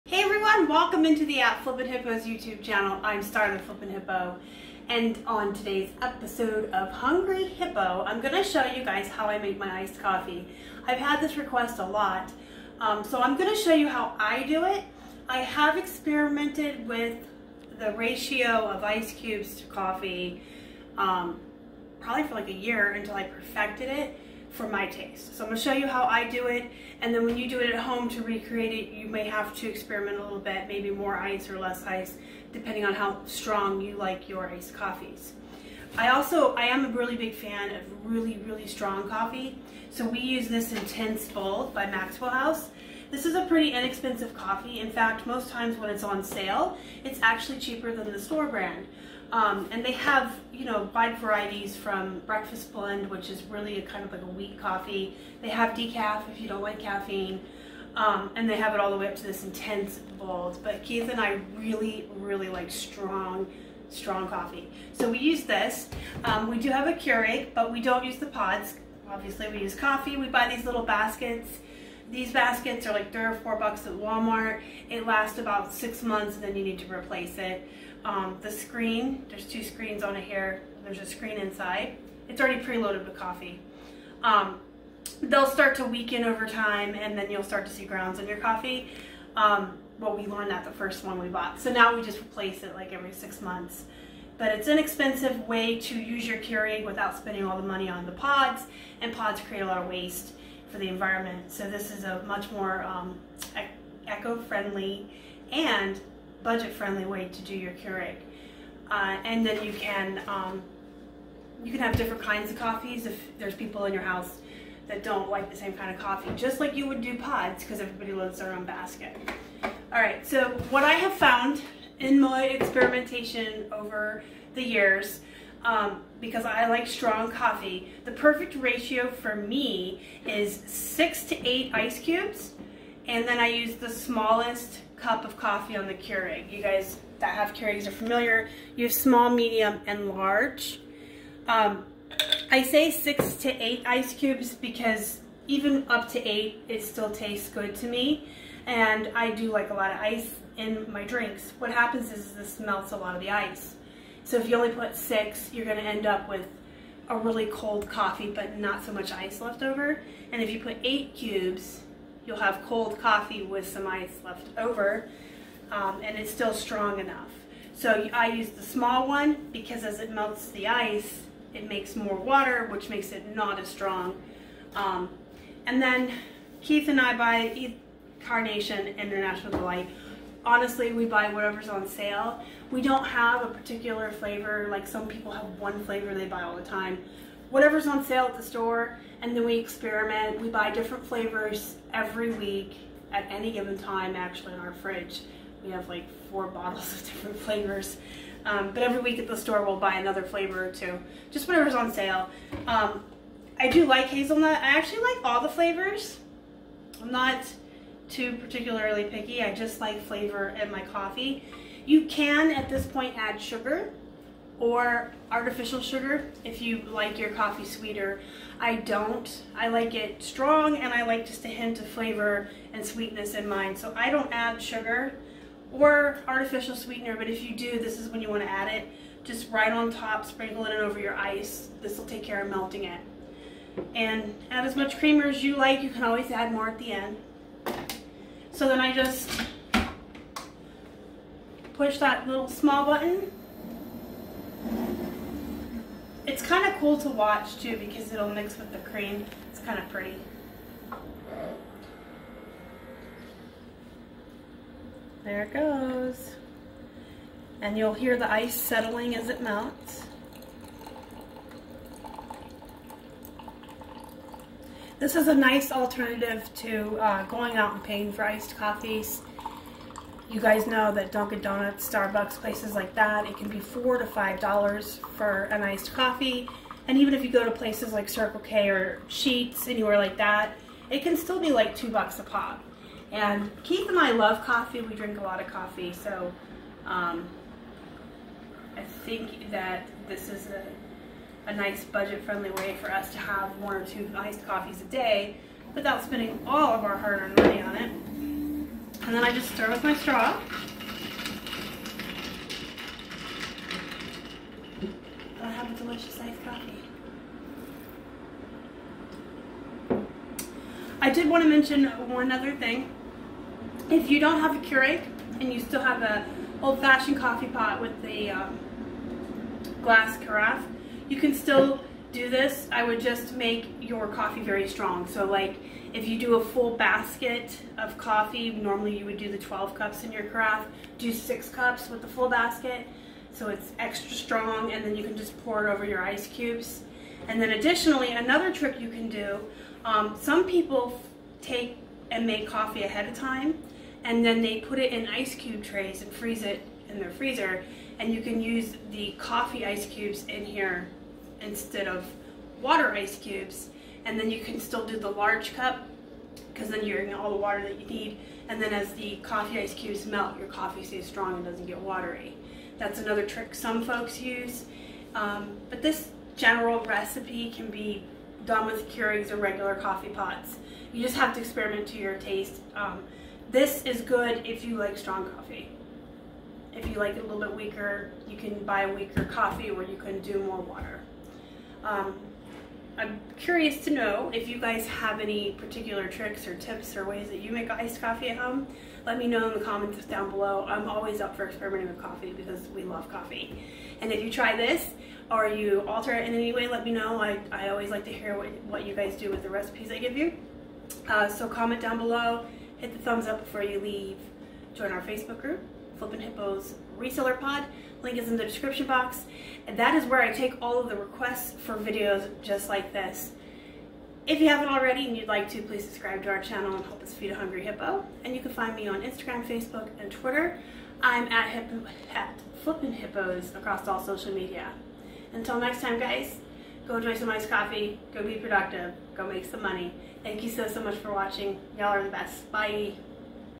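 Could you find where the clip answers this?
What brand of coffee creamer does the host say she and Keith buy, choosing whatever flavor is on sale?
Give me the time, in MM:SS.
02:58.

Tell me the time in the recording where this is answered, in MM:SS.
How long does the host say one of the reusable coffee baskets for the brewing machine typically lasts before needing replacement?
01:15.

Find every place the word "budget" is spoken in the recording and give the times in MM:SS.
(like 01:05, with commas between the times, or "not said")
01:46, 04:51.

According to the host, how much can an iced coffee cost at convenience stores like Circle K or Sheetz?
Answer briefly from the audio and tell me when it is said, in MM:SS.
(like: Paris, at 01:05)
$2, at 04:41.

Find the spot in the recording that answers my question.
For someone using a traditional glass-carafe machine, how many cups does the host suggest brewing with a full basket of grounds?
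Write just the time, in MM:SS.
05:31.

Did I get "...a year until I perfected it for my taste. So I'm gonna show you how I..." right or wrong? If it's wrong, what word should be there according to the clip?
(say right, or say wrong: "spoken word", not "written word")
right.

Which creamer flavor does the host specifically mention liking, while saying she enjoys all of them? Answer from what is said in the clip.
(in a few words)
Hazelnut.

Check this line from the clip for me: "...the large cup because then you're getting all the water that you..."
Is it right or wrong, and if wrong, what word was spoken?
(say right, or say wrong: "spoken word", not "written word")
right.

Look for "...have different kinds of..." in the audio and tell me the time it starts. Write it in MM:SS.
01:51.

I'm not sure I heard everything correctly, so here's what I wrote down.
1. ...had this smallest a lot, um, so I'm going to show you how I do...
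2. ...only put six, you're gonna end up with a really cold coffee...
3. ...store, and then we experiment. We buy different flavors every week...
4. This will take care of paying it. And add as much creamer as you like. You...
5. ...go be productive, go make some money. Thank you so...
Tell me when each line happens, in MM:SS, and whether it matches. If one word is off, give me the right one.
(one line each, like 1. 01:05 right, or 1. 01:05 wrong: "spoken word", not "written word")
1. 00:10 wrong: "request", not "smallest"
2. 02:34 right
3. 03:08 right
4. 03:51 wrong: "melting", not "paying"
5. 07:08 right.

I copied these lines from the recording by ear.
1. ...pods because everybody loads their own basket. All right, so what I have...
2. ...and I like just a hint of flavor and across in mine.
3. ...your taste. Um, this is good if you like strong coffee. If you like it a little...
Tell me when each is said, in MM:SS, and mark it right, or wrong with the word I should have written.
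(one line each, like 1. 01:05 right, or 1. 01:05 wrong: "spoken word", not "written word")
1. 01:57 right
2. 03:40 wrong: "sweetness", not "across"
3. 06:11 right.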